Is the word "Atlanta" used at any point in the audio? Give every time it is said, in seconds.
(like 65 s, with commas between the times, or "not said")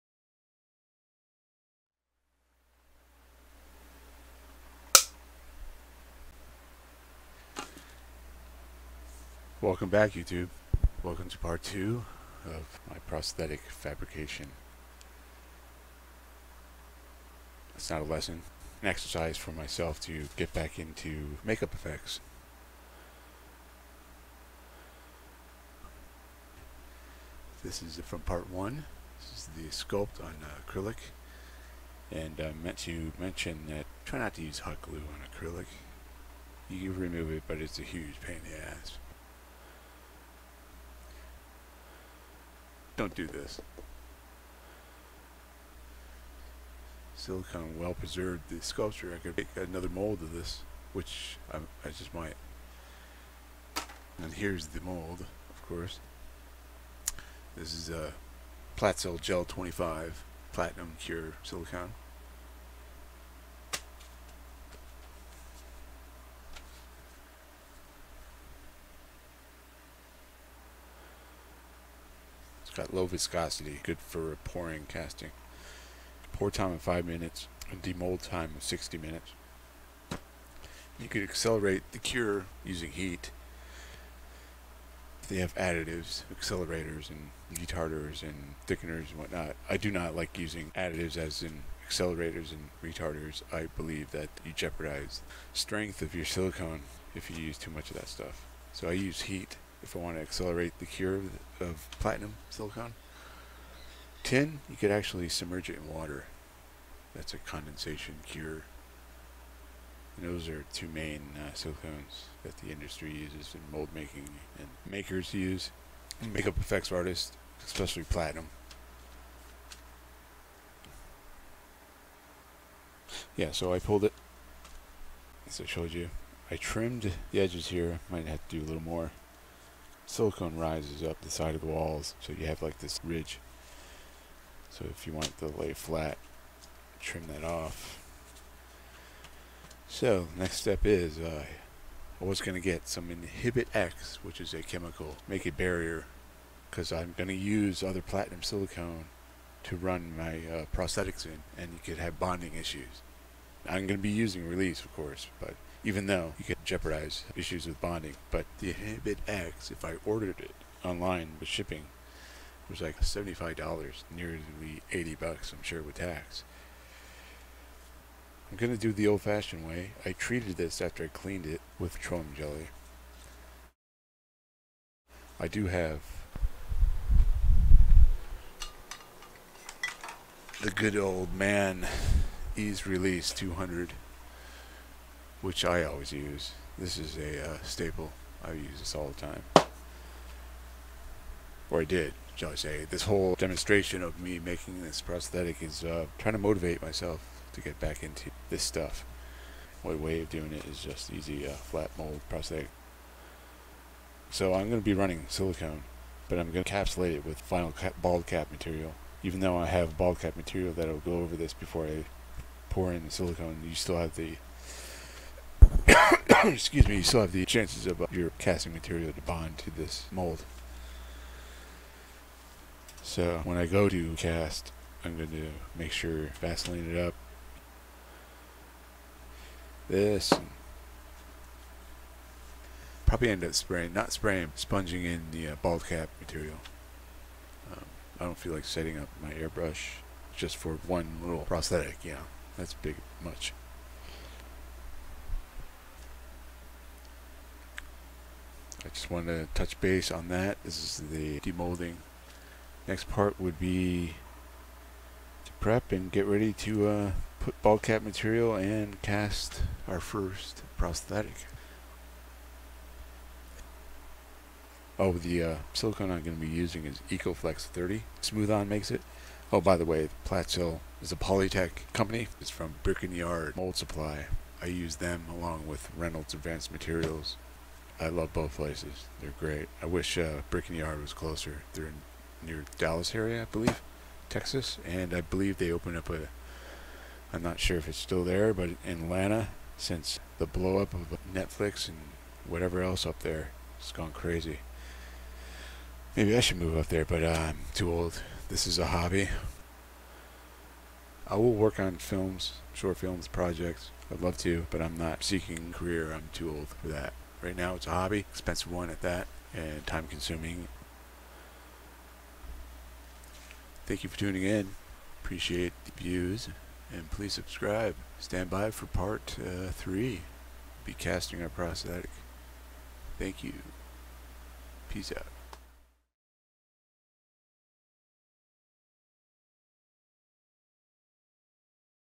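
289 s.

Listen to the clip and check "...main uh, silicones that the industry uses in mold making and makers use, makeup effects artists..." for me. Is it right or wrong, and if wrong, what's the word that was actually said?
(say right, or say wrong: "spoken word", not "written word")
right.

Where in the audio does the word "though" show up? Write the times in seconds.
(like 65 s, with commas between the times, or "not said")
156 s, 209 s.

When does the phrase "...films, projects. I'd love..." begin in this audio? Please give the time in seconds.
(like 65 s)
302 s.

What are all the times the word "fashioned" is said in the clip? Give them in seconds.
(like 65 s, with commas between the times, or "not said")
169 s.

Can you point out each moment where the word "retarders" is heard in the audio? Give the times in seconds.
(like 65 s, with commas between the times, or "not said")
87 s, 92 s.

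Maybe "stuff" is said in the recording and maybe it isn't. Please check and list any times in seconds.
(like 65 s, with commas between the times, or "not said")
98 s, 198 s.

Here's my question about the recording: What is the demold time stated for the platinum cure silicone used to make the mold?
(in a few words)
60 minutes.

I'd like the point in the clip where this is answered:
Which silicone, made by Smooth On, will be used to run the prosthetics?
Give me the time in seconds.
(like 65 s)
267 s.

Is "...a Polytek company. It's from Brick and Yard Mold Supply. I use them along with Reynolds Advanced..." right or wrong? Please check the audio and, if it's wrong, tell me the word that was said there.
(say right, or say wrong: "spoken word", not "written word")
right.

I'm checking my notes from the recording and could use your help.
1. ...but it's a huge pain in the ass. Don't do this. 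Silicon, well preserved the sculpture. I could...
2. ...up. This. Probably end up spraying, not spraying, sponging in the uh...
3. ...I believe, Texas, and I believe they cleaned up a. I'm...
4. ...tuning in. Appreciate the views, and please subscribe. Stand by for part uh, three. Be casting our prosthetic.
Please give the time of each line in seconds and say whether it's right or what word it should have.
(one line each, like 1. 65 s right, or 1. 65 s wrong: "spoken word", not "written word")
1. 37 s right
2. 226 s right
3. 283 s wrong: "opened", not "cleaned"
4. 314 s right.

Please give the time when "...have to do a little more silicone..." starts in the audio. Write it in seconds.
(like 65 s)
128 s.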